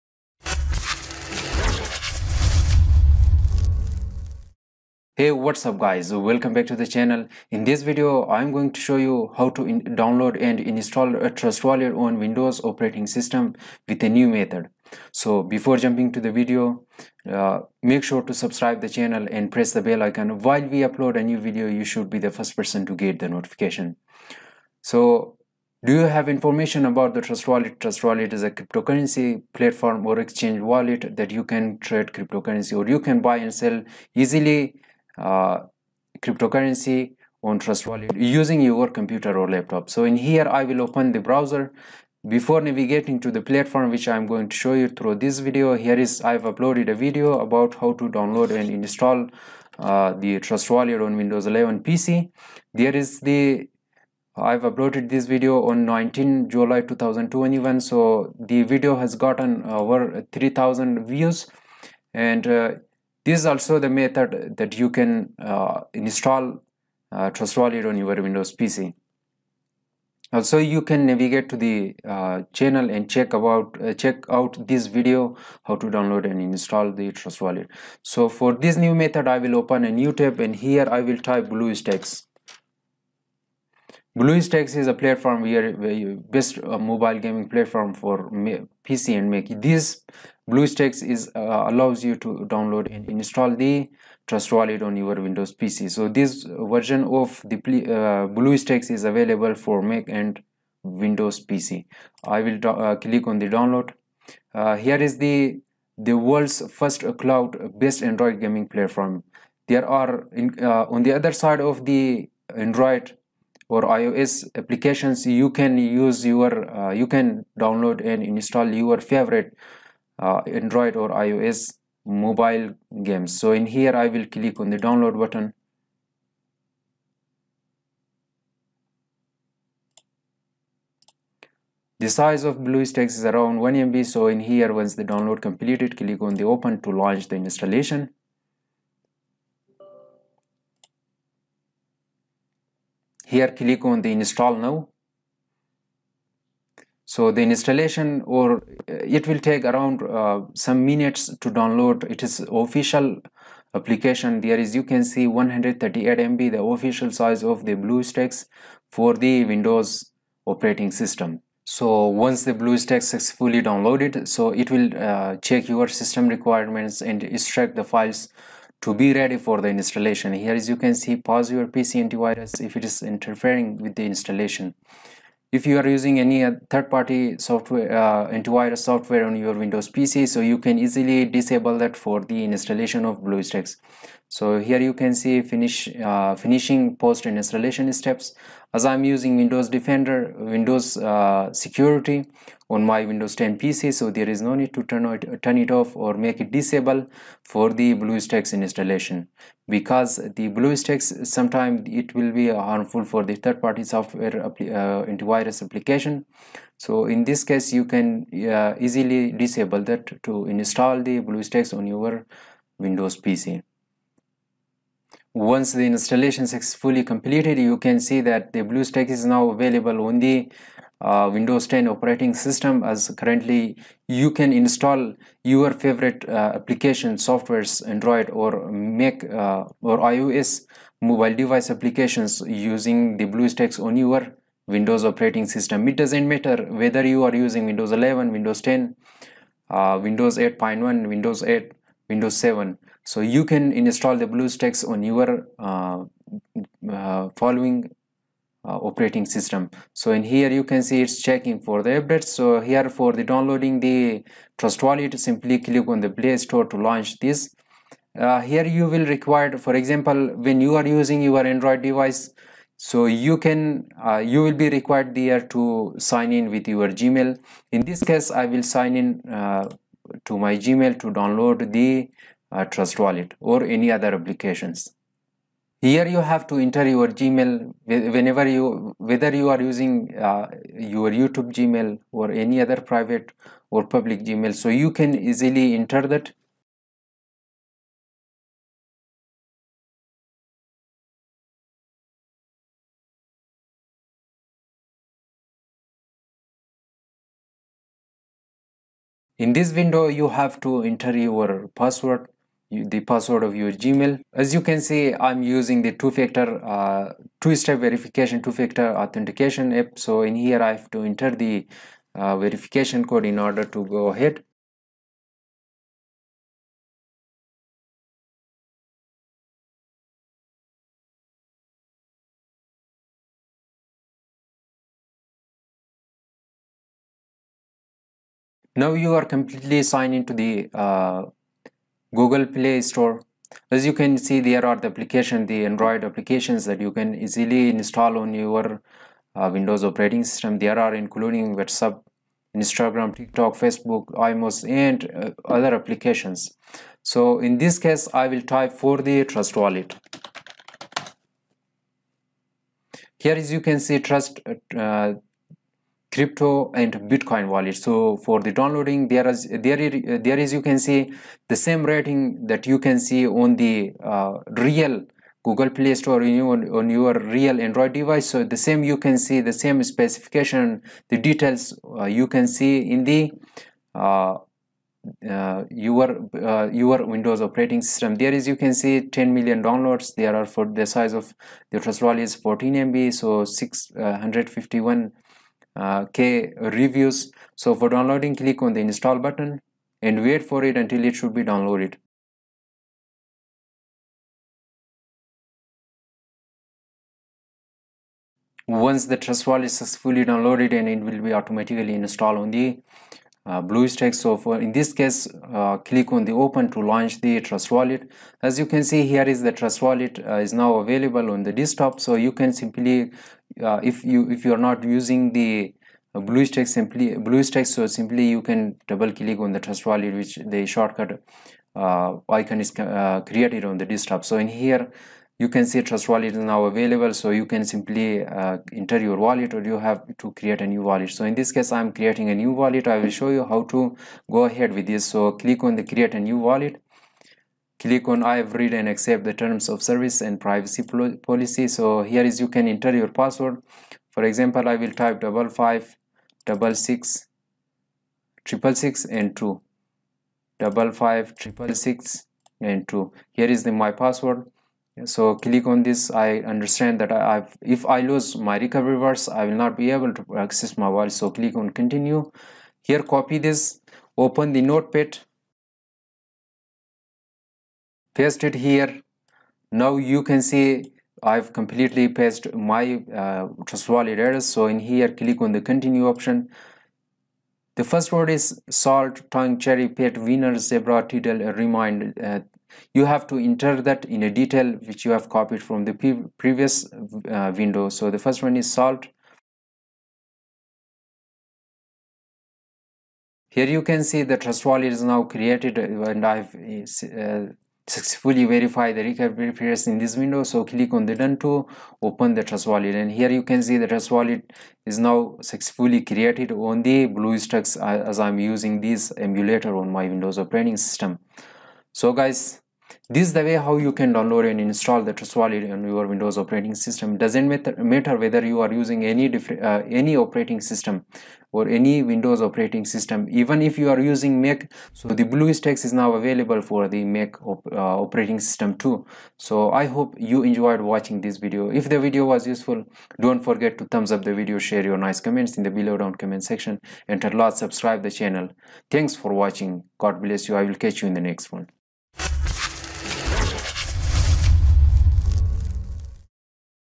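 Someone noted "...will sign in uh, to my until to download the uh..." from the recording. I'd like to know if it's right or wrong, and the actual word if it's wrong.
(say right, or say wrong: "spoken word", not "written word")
wrong: "gmail", not "until".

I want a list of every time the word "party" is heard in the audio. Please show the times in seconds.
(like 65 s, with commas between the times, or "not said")
176 s, 203 s.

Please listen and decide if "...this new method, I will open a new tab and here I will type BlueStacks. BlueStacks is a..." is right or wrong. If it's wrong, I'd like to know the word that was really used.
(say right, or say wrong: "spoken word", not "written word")
right.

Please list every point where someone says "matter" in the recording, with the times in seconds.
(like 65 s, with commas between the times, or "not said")
236 s, 517 s.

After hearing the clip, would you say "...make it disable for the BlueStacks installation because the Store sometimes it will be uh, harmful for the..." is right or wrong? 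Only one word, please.
wrong.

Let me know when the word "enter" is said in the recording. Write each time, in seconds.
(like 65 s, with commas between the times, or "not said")
276 s, 285 s, 300 s, 311 s, 428 s, 442 s, 483 s.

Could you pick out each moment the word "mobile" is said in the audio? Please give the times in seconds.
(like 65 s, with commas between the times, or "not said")
86 s, 122 s, 231 s.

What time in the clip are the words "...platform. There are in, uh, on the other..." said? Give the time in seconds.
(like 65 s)
108 s.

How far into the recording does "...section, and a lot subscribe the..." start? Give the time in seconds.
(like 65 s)
536 s.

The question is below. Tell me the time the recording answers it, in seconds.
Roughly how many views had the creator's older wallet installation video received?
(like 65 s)
59 s.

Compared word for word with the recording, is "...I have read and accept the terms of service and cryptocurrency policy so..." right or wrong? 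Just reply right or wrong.
wrong.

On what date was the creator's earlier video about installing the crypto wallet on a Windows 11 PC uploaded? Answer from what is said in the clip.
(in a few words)
19 July 2021.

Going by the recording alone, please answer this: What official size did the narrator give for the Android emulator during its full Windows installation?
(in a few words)
138 MB.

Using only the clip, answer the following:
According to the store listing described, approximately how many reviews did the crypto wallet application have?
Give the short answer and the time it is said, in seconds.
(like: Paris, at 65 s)
651K, at 383 s.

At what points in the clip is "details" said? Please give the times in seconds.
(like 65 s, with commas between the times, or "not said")
371 s, 484 s.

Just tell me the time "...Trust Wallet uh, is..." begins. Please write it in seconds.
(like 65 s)
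409 s.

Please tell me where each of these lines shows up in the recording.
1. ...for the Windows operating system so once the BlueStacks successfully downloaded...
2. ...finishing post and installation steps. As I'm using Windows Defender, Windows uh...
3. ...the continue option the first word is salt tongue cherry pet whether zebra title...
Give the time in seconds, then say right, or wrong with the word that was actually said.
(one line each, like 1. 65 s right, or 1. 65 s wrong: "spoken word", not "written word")
1. 158 s right
2. 186 s right
3. 475 s wrong: "winner", not "whether".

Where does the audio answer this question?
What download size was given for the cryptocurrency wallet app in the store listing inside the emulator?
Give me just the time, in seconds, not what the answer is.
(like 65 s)
382 s.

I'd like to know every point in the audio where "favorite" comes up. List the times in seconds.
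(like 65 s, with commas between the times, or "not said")
119 s, 225 s.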